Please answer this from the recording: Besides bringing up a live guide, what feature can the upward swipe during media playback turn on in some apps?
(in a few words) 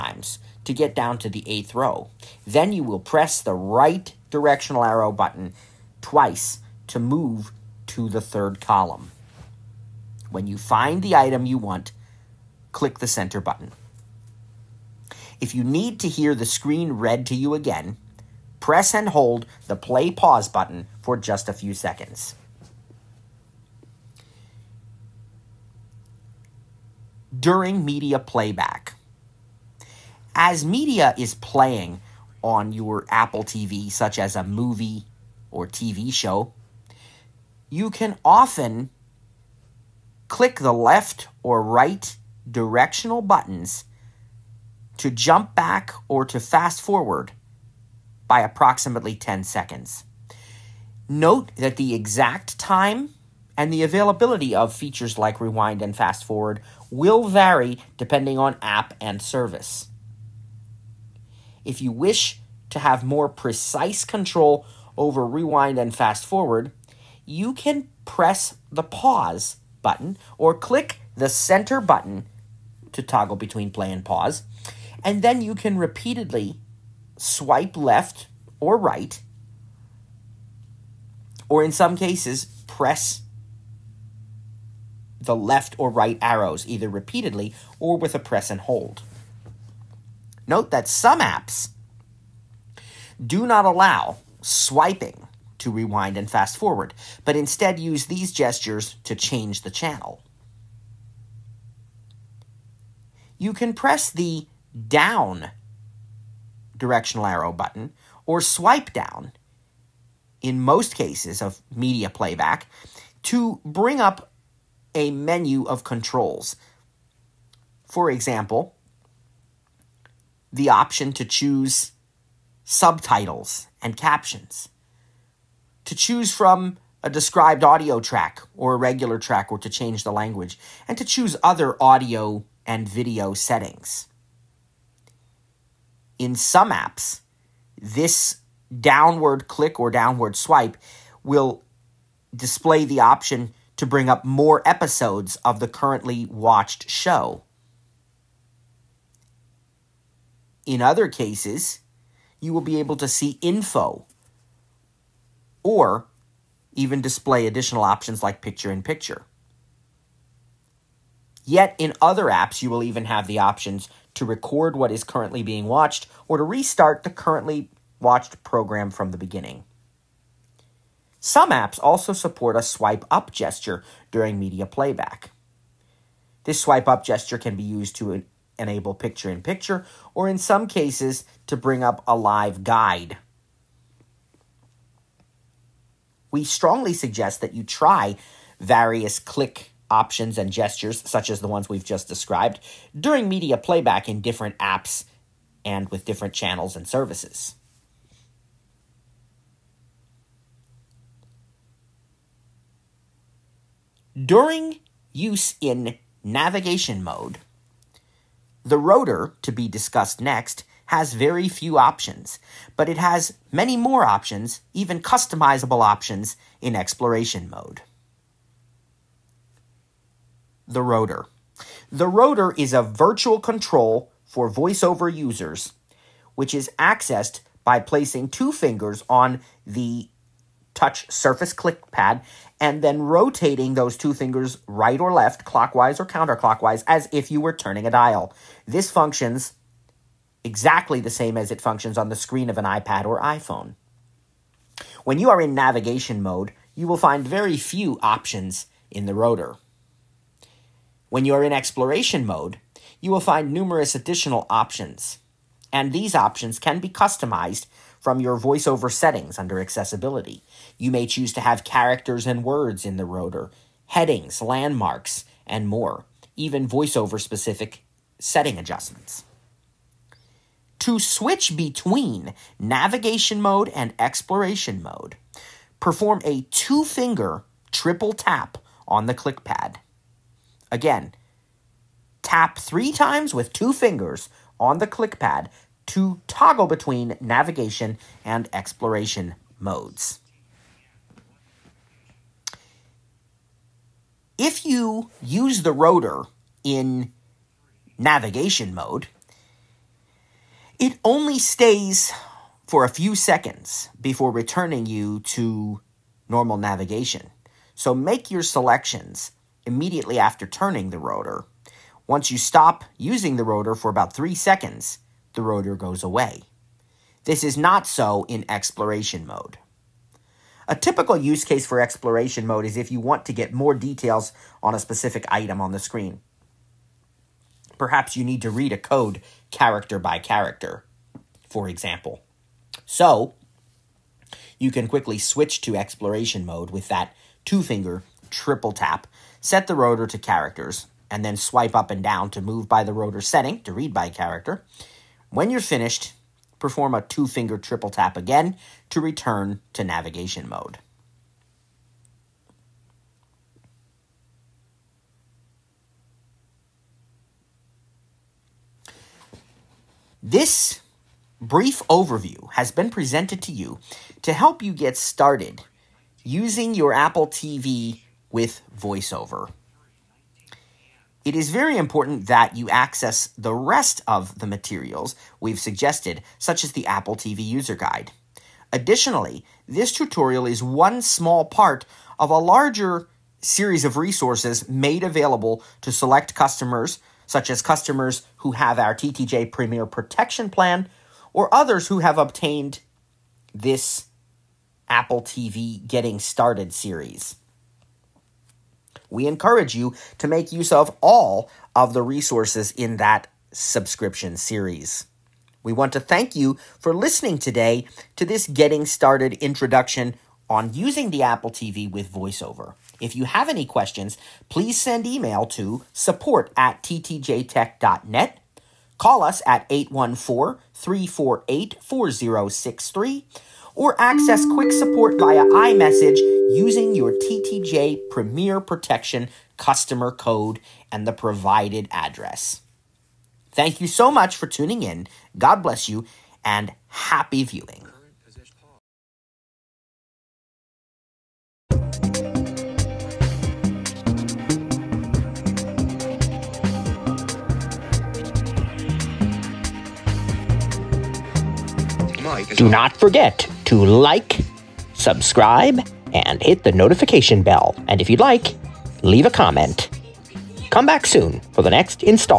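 picture in picture.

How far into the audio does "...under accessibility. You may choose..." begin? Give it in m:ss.
4:19.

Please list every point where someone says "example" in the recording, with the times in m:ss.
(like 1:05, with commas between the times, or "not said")
1:58, 5:31.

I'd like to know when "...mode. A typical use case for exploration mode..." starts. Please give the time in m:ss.
5:19.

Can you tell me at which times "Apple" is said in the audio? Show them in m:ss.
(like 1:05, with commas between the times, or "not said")
0:33, 6:06, 6:16, 6:34, 6:51.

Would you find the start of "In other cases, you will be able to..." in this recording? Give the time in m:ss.
2:30.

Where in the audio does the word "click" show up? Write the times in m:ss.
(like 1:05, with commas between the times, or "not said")
0:12, 0:40, 1:10, 2:19, 3:09, 3:51, 4:39, 4:44.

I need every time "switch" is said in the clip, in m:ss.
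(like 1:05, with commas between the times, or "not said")
4:30, 5:35.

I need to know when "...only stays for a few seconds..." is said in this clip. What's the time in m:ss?
5:01.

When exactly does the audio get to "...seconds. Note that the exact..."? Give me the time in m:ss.
0:49.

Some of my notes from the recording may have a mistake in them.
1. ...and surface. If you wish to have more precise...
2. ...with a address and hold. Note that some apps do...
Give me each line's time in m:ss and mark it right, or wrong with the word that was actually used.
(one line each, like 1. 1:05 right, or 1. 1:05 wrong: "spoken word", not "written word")
1. 0:59 wrong: "service", not "surface"
2. 1:27 wrong: "press", not "address".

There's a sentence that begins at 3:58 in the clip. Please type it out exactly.
This functions exactly the same as it functions on the screen of an iPad or iPhone.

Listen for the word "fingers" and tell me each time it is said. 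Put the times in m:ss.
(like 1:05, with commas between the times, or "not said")
3:48, 3:54, 4:36, 4:43, 5:37, 5:47.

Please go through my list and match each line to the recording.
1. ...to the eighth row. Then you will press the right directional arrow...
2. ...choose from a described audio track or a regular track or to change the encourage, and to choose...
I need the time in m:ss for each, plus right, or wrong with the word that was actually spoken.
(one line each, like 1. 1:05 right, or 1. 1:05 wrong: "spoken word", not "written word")
1. 0:01 right
2. 2:05 wrong: "language", not "encourage".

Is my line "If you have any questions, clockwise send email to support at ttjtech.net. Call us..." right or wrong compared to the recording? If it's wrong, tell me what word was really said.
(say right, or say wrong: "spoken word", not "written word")
wrong: "please", not "clockwise".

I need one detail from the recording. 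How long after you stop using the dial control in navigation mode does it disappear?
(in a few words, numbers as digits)
3 seconds.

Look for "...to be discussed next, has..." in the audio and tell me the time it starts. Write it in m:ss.
3:29.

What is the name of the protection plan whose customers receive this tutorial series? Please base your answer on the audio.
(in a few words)
TTJ Premier Protection Plan.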